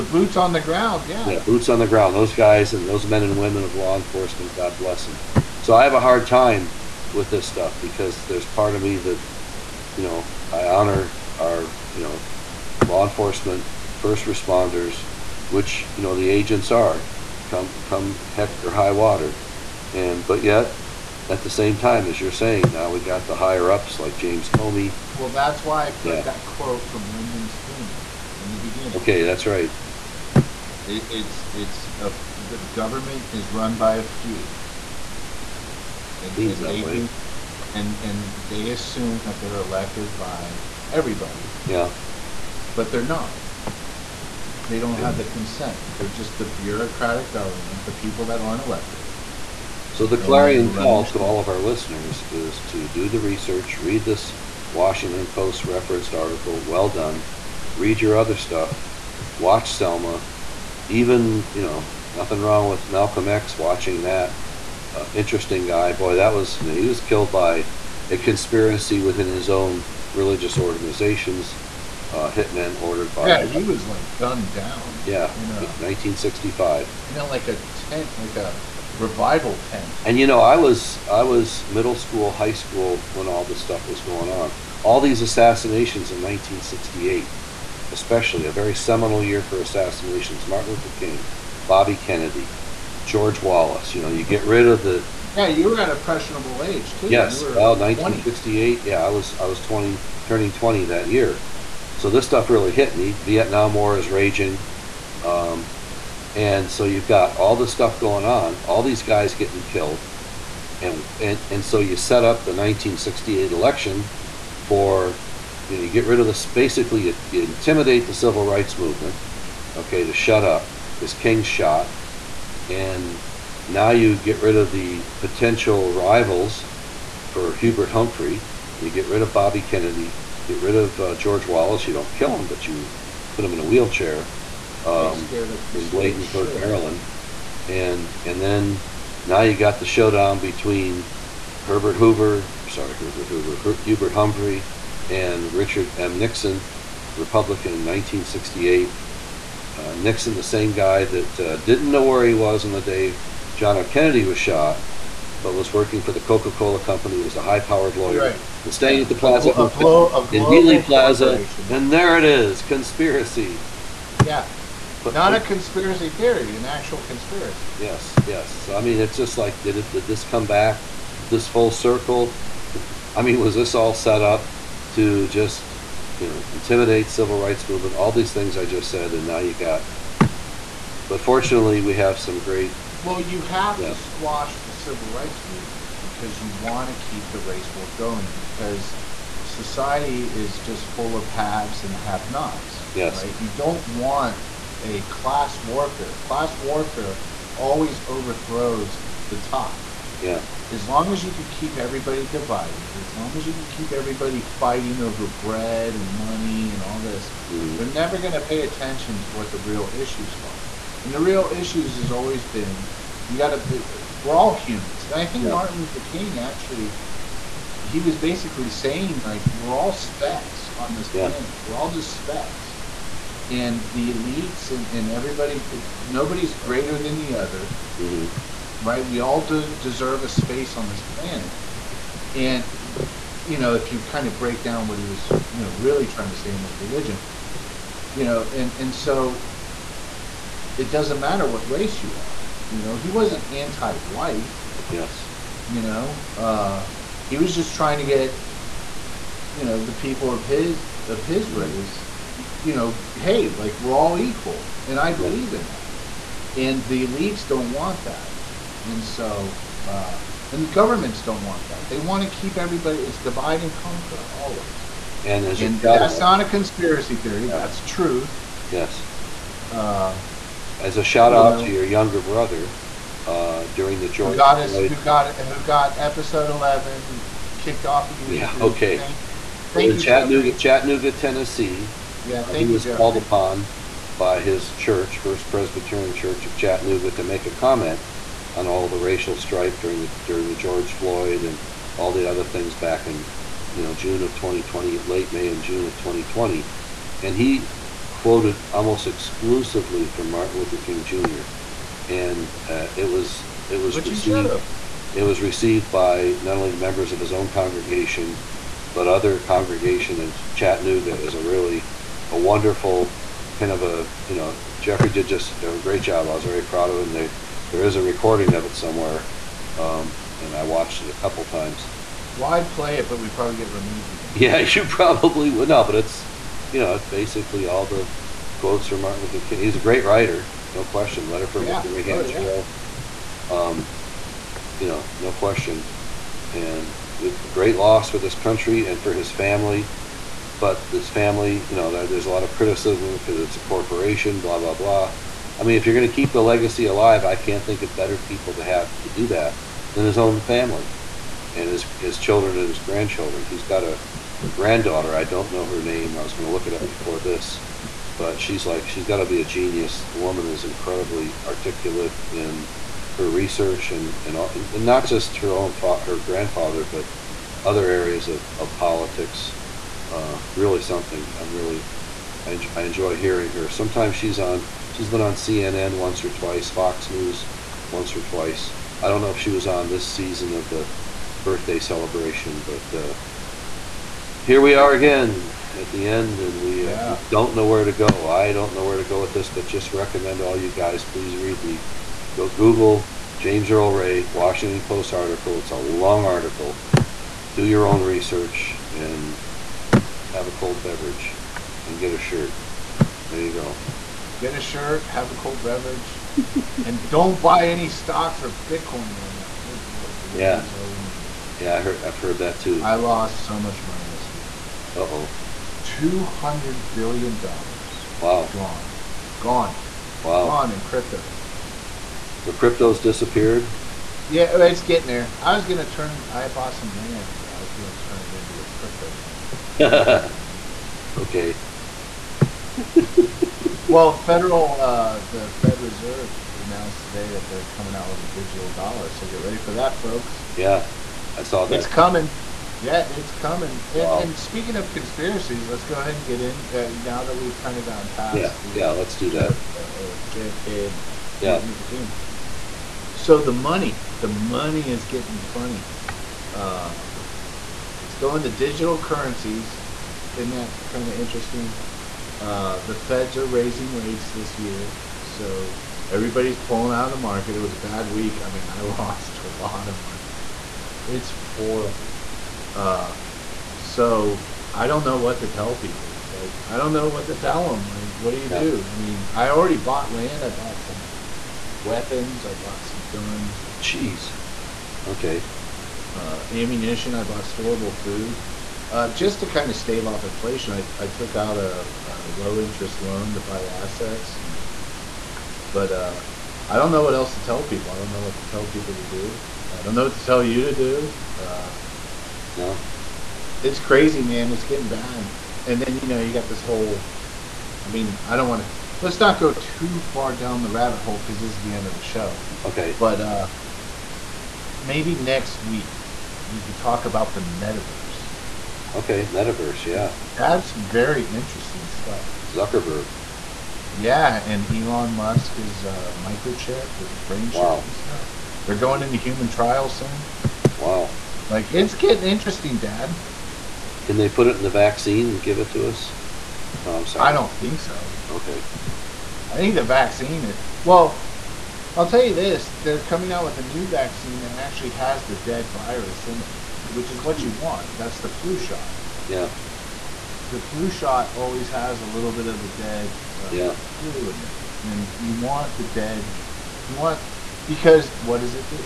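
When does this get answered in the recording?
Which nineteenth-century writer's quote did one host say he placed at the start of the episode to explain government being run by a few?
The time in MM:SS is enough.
00:27.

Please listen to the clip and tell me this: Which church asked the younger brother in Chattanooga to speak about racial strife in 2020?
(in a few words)
First Presbyterian Church of Chattanooga.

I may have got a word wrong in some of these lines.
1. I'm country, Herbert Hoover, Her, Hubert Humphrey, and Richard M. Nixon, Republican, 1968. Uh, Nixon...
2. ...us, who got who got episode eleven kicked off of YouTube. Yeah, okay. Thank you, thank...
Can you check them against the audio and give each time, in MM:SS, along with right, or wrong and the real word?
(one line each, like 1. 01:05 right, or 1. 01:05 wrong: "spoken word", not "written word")
1. 02:22 wrong: "sorry", not "country"
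2. 04:34 right.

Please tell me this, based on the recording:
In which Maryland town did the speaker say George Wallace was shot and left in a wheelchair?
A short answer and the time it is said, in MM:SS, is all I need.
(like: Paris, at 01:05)
Bladensburg, at 02:15.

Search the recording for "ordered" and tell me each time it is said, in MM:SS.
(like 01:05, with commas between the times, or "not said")
01:12.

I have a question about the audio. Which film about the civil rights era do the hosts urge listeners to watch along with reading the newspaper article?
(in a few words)
Selma.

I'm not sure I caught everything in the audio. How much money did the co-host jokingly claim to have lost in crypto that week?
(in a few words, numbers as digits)
200 billion dollars.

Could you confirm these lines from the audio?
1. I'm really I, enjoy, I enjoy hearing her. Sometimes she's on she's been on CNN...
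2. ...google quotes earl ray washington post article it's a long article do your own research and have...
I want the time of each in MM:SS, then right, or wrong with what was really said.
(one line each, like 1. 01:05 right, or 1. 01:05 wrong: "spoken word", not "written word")
1. 06:11 right
2. 06:32 wrong: "james", not "quotes".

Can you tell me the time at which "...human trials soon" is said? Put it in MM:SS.
08:49.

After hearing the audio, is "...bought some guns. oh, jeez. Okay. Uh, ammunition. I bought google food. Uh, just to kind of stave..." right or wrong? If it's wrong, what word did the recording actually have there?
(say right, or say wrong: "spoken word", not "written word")
wrong: "storable", not "google".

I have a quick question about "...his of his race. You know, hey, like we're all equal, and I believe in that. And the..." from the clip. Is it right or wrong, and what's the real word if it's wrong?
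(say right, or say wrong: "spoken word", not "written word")
right.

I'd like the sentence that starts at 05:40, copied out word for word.
But this family, you know, there, there's a lot of criticisms because it's a corporation, blah blah blah.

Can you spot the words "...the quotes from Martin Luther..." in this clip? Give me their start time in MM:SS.
05:27.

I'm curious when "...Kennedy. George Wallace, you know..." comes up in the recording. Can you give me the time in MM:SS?
01:31.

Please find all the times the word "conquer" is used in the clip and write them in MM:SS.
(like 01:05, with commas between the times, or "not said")
04:23.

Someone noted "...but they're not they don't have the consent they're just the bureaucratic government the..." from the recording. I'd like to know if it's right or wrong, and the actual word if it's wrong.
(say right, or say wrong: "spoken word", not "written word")
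right.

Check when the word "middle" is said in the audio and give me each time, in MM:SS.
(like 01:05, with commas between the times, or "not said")
01:21.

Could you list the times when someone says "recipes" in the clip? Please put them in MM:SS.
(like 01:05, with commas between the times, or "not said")
not said.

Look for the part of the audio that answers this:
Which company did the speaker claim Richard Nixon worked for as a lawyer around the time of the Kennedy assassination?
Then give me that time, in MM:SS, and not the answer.
02:36.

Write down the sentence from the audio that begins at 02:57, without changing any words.
All these things I just said, and now you got.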